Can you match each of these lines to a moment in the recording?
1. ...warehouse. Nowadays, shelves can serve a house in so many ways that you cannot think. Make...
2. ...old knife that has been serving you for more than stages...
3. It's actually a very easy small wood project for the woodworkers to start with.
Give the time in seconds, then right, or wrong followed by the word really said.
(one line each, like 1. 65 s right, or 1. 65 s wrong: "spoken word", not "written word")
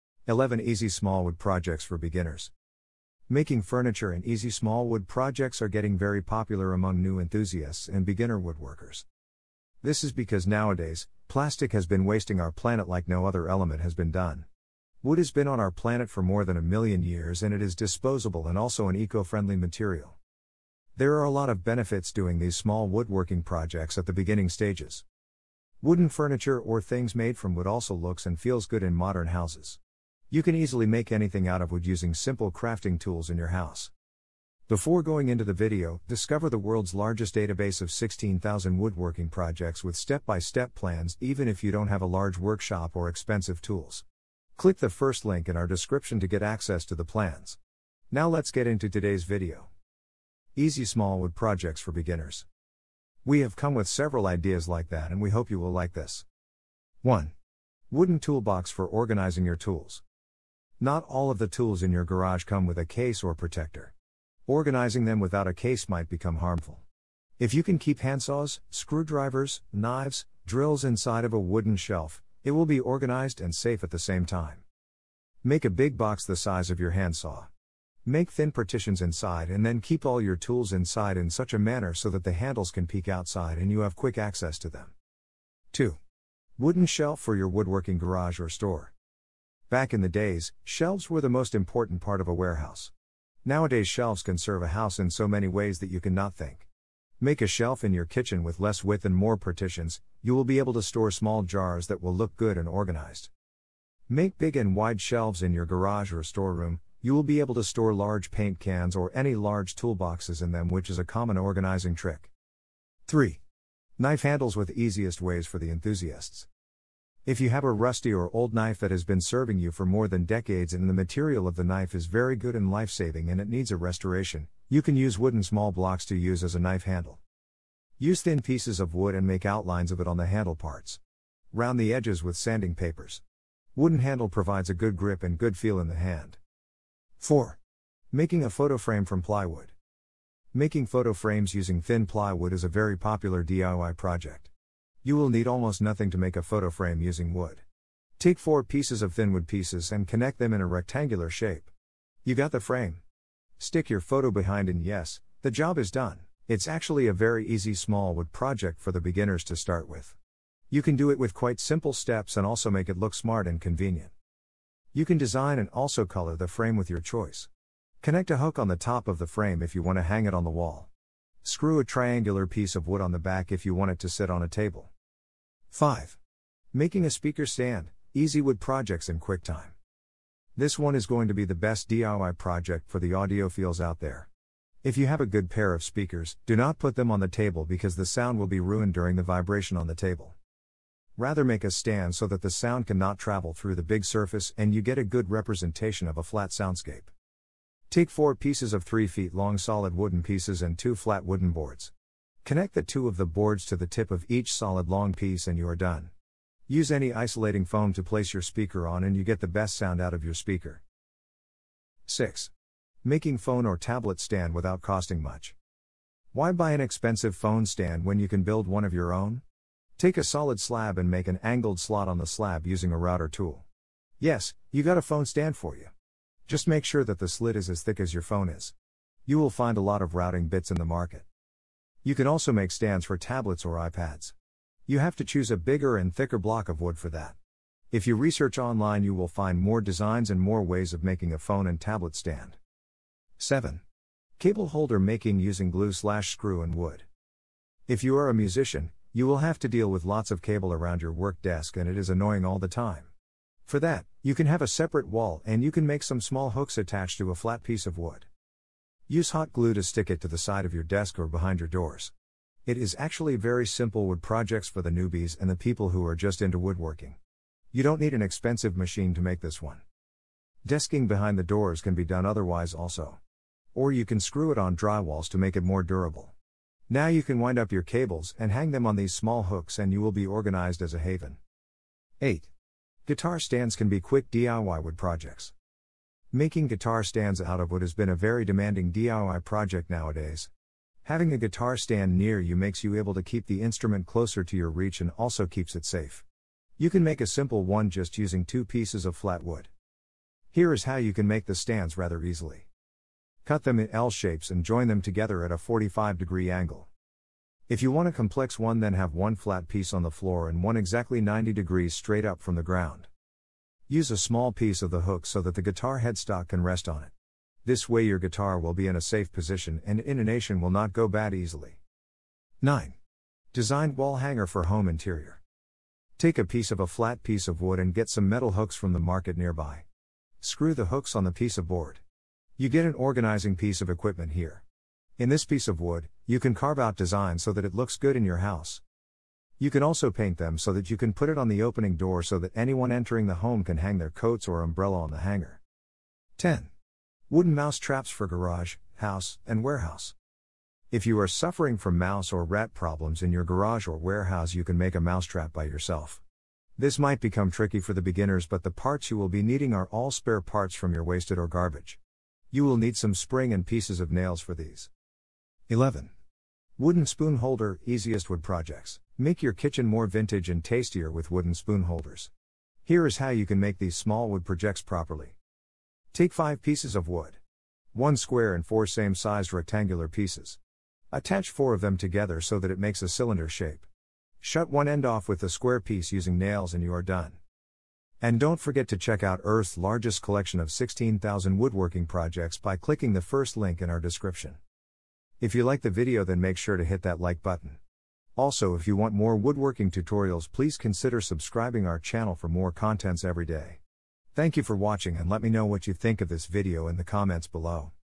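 1. 92 s right
2. 118 s wrong: "decades", not "stages"
3. 156 s wrong: "beginners", not "woodworkers".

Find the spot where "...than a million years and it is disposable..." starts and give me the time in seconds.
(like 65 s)
16 s.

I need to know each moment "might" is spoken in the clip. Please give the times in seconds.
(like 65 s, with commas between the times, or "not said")
65 s, 356 s.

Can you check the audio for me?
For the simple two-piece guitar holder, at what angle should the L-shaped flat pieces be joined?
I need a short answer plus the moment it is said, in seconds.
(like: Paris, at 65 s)
45 degrees, at 305 s.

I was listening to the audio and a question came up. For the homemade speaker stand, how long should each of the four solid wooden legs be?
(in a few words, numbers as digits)
3 feet.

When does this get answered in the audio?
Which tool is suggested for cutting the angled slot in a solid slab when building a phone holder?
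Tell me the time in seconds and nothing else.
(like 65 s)
222 s.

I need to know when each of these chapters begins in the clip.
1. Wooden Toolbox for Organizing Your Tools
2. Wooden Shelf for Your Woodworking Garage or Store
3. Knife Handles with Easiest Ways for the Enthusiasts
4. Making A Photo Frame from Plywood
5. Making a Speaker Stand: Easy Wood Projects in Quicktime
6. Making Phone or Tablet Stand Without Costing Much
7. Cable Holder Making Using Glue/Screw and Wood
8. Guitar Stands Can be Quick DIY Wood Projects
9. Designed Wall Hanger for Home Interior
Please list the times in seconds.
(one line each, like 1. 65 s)
1. 57 s
2. 85 s
3. 112 s
4. 135 s
5. 175 s
6. 211 s
7. 243 s
8. 282 s
9. 322 s.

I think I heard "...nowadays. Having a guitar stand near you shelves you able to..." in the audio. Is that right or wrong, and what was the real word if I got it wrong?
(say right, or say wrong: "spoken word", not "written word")
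wrong: "makes", not "shelves".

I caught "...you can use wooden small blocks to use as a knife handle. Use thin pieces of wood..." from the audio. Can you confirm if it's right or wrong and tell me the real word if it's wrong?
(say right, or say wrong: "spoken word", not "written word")
right.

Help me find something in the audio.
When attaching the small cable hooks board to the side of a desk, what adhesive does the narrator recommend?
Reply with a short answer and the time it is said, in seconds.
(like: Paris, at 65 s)
hot glue, at 259 s.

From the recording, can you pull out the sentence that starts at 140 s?
Making photo frames using thin plywood is a very popular DIY project.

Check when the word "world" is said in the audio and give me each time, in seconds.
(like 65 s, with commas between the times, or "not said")
36 s.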